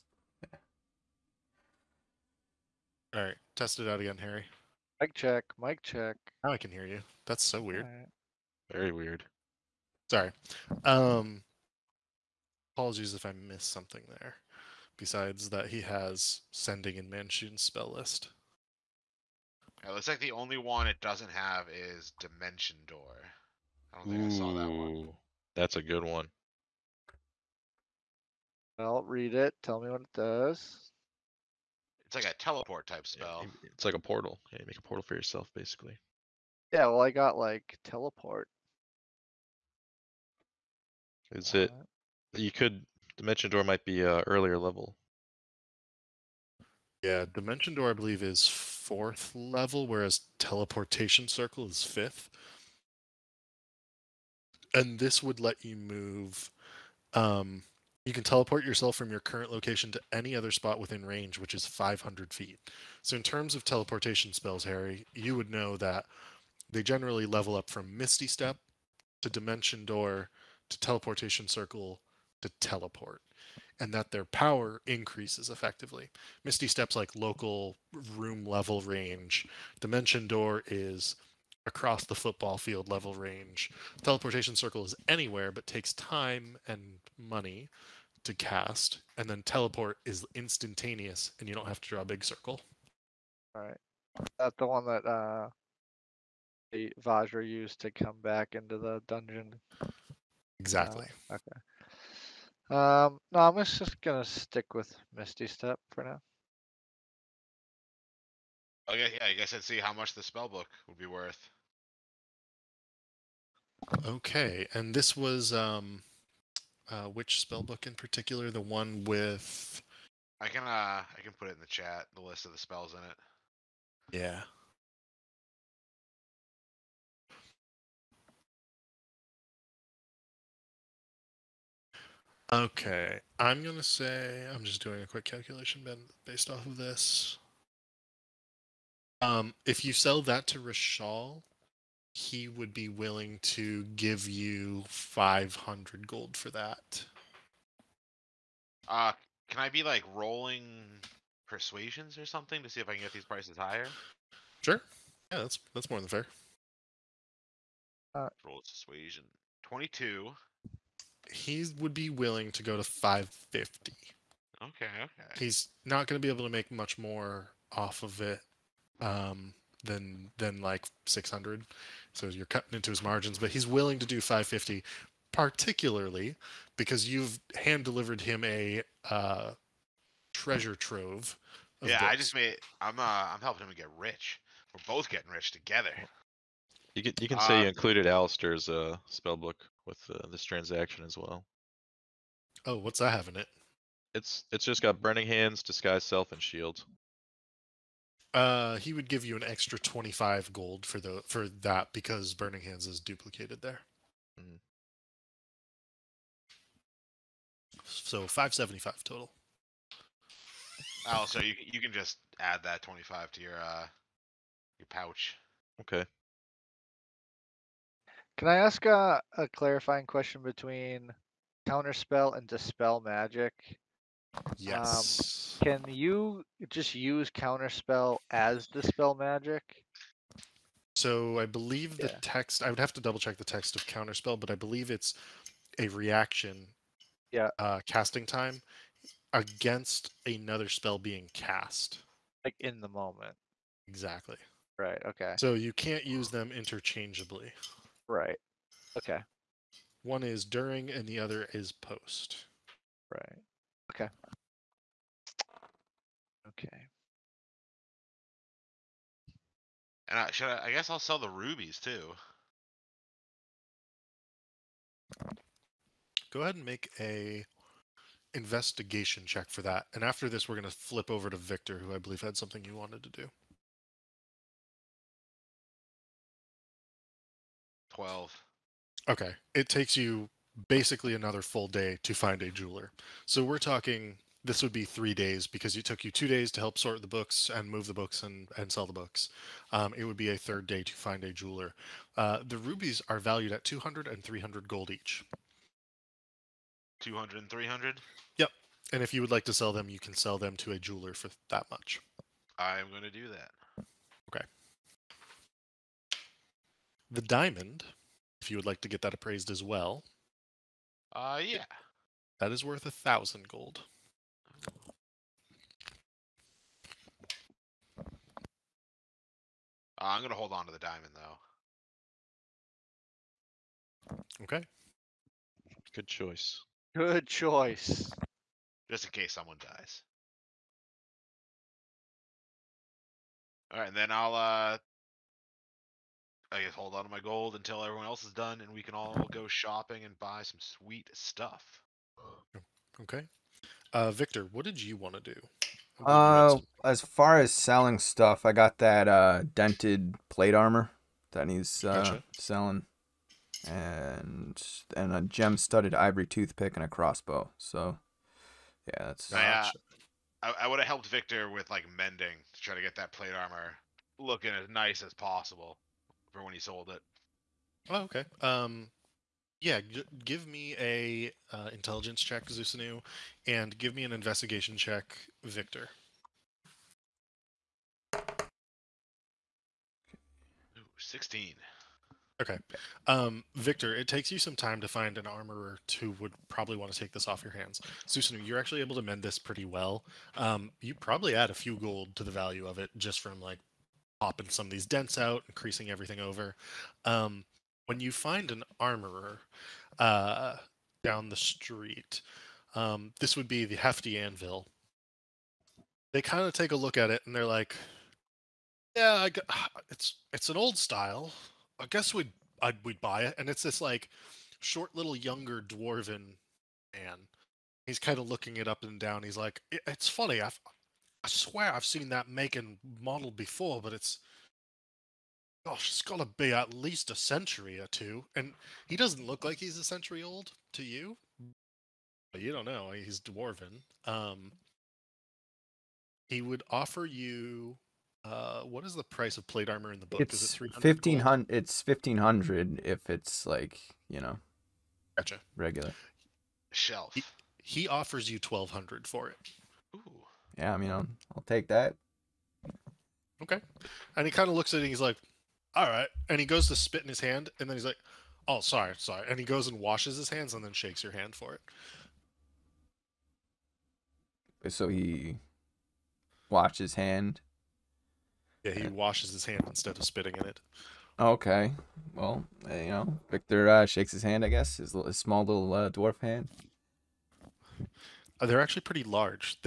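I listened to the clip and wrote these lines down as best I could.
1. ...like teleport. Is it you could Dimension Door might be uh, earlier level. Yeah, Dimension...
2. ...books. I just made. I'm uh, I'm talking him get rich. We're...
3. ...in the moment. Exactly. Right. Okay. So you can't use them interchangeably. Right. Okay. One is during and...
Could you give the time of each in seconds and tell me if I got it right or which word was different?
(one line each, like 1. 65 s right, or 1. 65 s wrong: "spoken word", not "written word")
1. 37 s right
2. 181 s wrong: "helping", not "talking"
3. 242 s right.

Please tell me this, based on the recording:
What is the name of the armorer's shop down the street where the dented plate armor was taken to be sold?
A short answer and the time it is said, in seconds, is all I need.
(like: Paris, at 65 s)
The Hefty Anvil, at 403 s.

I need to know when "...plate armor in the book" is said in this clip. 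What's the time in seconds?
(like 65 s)
439 s.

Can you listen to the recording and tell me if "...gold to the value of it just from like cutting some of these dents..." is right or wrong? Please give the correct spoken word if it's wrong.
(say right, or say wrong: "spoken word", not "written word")
wrong: "popping", not "cutting".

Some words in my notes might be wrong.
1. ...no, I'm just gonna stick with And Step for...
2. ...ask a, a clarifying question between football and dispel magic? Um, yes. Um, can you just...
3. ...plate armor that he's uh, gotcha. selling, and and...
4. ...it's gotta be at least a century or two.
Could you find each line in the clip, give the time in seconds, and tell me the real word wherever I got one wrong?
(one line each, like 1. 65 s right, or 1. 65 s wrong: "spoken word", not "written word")
1. 103 s wrong: "Misty", not "And"
2. 218 s wrong: "counterspell", not "football"
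3. 350 s right
4. 425 s right.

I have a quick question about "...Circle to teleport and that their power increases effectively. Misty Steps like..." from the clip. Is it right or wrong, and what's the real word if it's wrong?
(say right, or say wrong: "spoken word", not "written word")
right.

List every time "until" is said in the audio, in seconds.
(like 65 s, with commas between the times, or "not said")
337 s.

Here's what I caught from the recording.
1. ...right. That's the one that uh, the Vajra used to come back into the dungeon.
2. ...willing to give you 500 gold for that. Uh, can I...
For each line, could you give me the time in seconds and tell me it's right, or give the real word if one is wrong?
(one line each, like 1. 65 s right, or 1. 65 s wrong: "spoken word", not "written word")
1. 93 s right
2. 142 s right.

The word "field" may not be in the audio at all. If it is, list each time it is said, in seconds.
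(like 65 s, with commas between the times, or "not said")
82 s.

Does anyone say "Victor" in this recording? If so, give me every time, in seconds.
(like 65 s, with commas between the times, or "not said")
271 s, 344 s, 361 s, 375 s, 383 s, 473 s.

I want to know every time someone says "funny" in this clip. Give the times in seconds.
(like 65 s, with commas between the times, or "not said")
420 s.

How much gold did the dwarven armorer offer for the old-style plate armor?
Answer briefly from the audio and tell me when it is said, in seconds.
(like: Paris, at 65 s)
1200, at 448 s.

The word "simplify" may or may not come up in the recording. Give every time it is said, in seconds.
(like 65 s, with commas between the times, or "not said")
not said.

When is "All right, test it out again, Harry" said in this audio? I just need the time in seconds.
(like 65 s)
3 s.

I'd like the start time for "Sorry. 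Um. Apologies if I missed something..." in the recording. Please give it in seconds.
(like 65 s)
10 s.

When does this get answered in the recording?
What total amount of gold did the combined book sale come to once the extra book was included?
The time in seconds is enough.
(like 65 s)
208 s.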